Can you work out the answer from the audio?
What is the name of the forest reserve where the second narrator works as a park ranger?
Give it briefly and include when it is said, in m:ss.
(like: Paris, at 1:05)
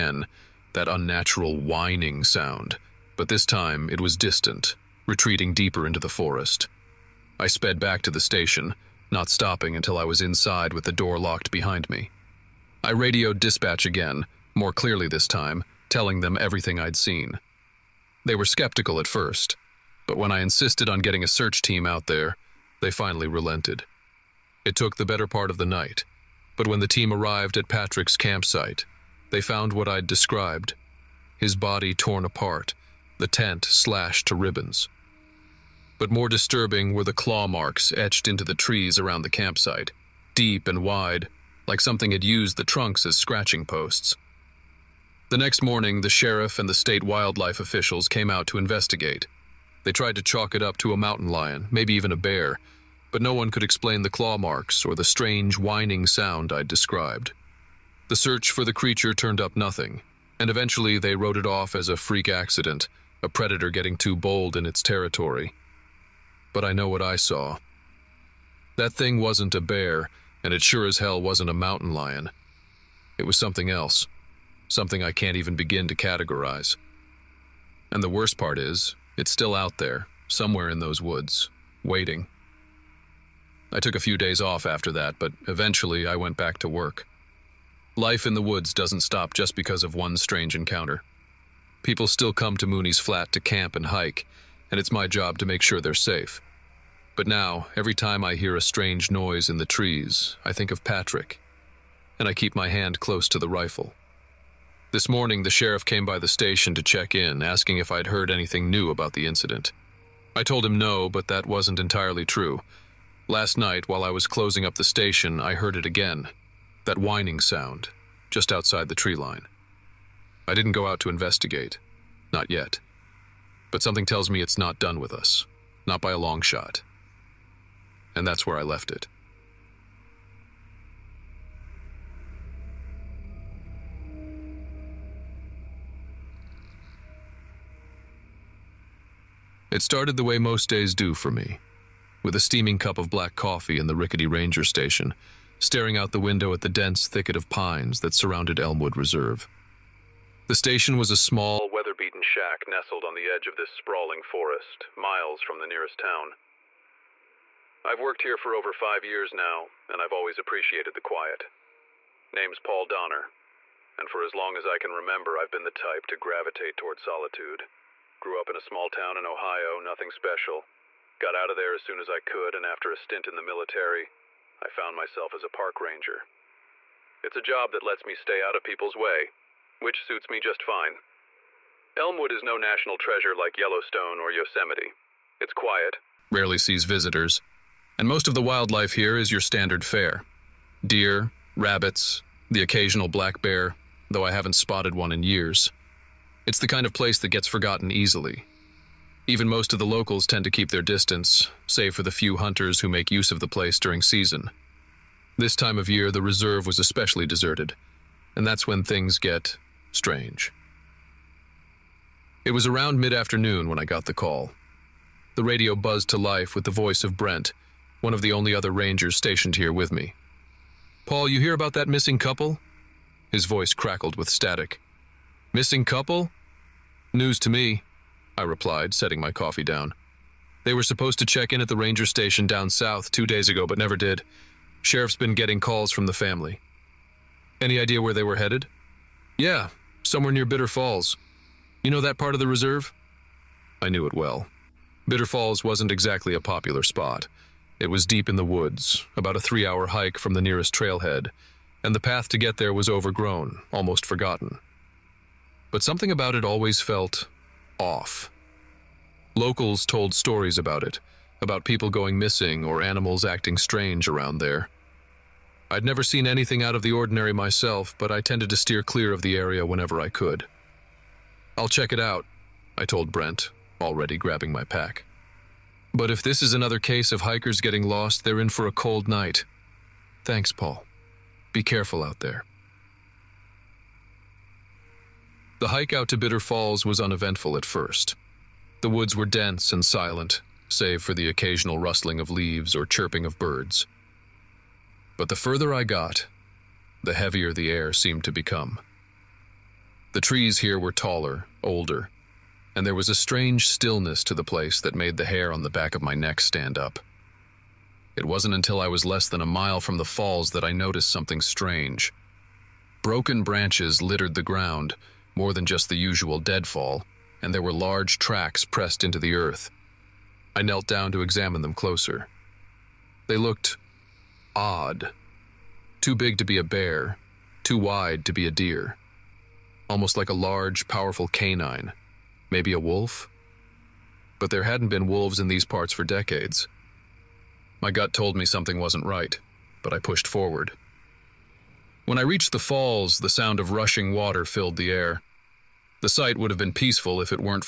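Elmwood Reserve, at 2:28.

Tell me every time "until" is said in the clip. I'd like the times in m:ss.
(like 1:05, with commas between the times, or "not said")
0:09, 5:08.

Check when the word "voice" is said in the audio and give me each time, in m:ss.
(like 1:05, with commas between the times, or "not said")
3:36, 3:43.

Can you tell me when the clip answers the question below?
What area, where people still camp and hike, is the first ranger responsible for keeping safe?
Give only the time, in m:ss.
1:32.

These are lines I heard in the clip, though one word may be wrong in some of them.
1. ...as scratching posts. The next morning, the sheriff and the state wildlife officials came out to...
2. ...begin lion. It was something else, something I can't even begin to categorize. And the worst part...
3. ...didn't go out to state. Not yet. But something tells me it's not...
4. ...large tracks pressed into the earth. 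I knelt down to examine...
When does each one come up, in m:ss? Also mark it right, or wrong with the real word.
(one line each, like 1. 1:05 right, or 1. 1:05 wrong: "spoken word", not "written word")
1. 0:43 right
2. 1:11 wrong: "mountain", not "begin"
3. 2:00 wrong: "investigate", not "state"
4. 5:17 right.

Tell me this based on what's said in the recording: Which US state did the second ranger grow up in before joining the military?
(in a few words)
Ohio.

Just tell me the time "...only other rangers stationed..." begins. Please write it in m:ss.
3:38.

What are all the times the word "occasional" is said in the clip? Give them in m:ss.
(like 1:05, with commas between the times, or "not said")
3:12, 4:51.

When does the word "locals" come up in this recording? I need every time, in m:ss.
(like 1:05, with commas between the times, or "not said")
3:19, 4:19.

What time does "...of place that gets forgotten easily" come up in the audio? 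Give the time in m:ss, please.
3:16.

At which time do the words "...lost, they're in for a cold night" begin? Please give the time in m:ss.
4:37.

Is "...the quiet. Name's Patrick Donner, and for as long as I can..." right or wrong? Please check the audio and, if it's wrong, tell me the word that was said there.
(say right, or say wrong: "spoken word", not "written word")
wrong: "Paul", not "Patrick".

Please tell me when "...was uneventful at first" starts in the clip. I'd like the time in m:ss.
4:46.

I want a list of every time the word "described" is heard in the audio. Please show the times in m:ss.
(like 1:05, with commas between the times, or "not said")
0:30, 0:56.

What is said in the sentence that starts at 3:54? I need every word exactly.
Sheriff's been getting calls from the family.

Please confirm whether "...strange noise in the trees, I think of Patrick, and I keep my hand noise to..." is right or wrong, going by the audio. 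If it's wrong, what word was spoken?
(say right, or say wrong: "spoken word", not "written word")
wrong: "close", not "noise".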